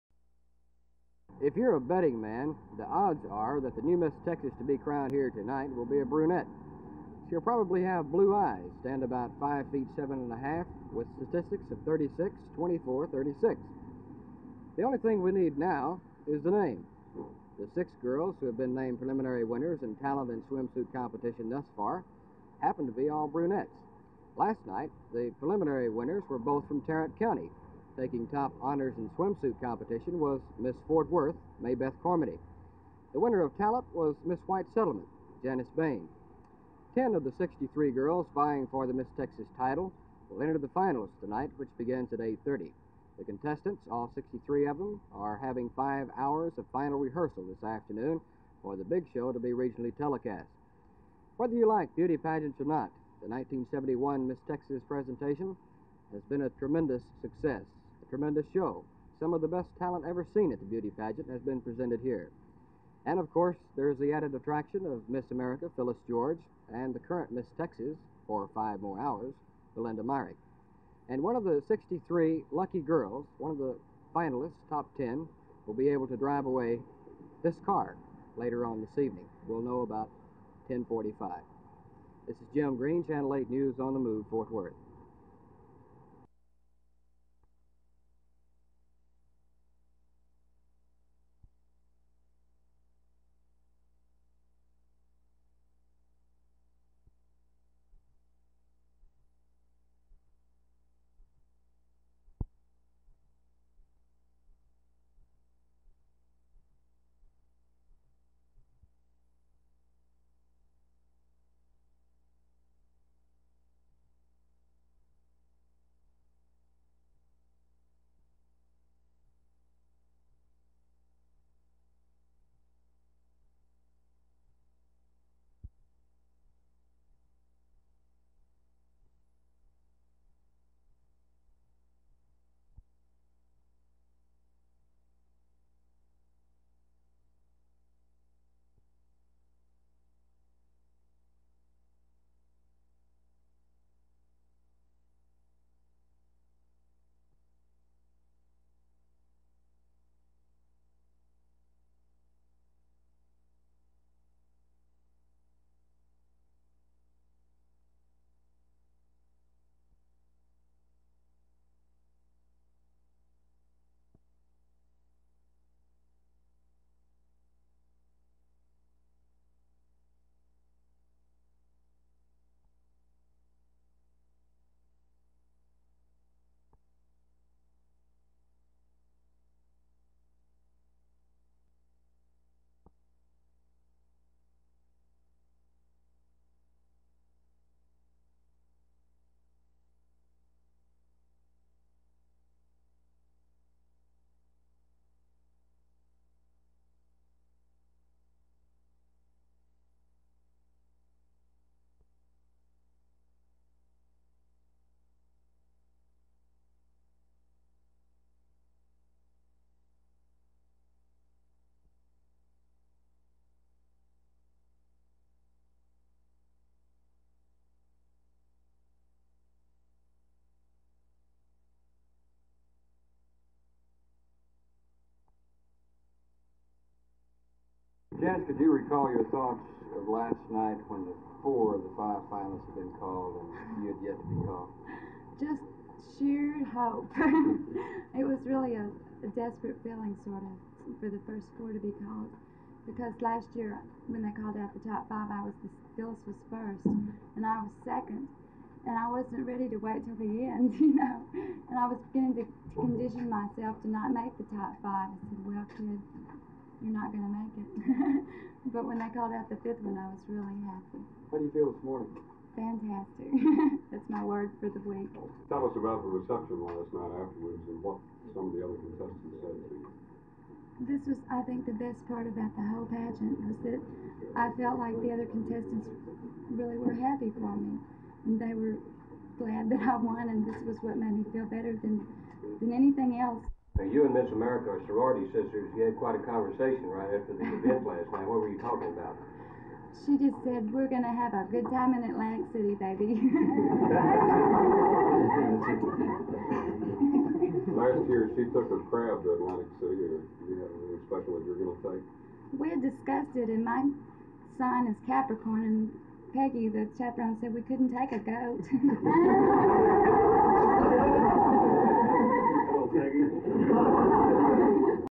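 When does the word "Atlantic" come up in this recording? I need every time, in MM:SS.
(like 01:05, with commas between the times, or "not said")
04:52, 04:59.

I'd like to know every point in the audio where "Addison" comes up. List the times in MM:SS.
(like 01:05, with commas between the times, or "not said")
not said.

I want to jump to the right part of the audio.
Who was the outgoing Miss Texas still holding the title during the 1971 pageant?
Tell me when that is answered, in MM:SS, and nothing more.
01:09.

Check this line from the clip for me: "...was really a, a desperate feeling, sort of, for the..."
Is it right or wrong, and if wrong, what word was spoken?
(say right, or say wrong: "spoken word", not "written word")
right.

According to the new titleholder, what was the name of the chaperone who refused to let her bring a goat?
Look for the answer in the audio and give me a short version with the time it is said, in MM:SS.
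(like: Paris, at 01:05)
Peggy, at 05:06.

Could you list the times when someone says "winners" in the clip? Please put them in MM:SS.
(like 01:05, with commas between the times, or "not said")
00:19, 00:25, 00:33.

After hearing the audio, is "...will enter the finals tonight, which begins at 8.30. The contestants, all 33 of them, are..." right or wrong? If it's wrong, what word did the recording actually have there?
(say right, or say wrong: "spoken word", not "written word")
wrong: "63", not "33".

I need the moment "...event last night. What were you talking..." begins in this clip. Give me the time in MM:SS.
04:47.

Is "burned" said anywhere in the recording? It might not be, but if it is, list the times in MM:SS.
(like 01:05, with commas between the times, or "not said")
not said.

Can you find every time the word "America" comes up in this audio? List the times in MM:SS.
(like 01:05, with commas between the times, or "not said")
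01:05, 04:44.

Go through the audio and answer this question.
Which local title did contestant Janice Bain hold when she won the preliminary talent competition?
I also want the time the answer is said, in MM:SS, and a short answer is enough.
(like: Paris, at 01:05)
Miss White Settlement, at 00:34.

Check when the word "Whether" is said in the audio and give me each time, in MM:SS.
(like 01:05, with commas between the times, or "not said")
00:51.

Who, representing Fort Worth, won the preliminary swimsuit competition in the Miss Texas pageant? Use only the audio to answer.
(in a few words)
Maybeth Cormody.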